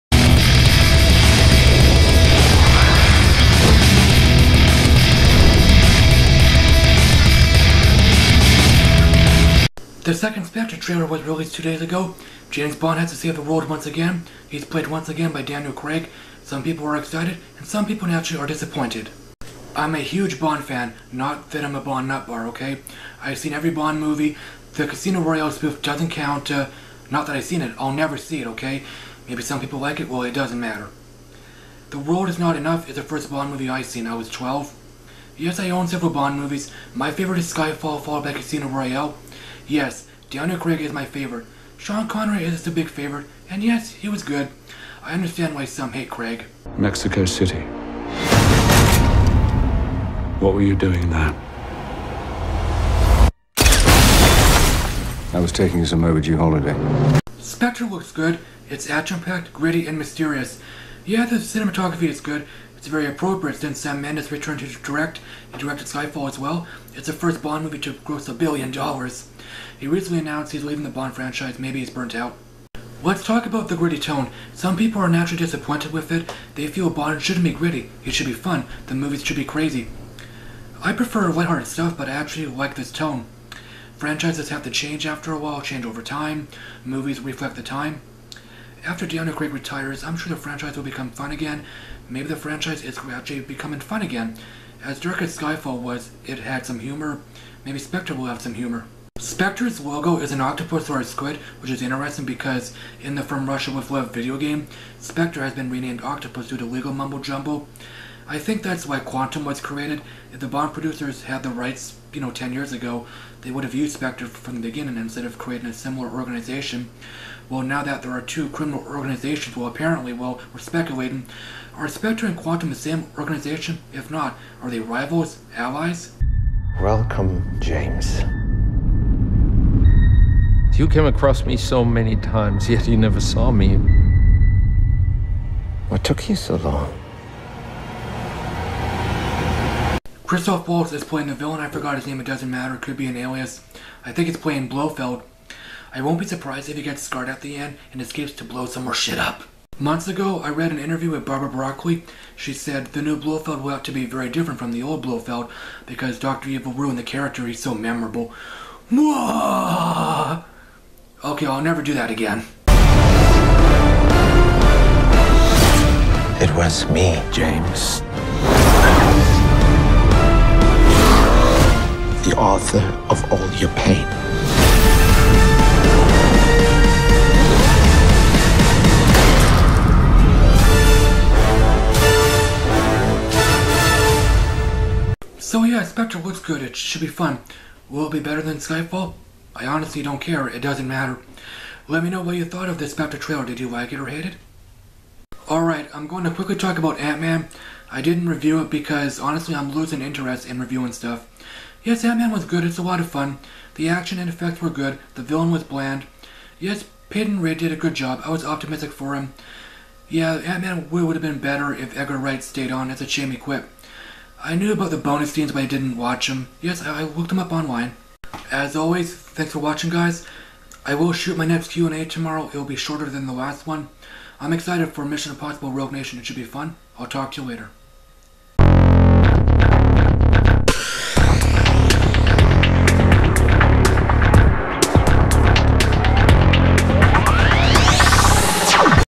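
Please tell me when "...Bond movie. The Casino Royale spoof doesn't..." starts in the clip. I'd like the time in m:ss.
0:23.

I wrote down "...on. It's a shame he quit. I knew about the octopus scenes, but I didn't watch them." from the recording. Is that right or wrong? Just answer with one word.
wrong.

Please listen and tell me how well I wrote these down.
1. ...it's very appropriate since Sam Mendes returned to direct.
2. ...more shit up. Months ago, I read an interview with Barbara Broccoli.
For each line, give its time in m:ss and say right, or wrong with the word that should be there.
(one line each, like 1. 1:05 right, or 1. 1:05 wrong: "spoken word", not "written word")
1. 1:02 right
2. 2:28 right.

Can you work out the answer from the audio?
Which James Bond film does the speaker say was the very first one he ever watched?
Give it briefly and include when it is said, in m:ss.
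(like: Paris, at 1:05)
The World Is Not Enough, at 0:31.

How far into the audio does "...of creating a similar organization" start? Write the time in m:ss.
1:55.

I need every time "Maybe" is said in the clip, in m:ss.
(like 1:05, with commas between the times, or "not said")
0:29, 1:11, 1:32, 1:37.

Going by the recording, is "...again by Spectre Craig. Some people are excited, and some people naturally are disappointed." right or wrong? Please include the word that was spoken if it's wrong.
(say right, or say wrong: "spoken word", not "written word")
wrong: "Daniel", not "Spectre".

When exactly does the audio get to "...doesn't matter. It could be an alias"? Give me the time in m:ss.
2:22.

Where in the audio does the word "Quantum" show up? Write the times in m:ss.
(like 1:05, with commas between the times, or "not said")
1:48, 2:02.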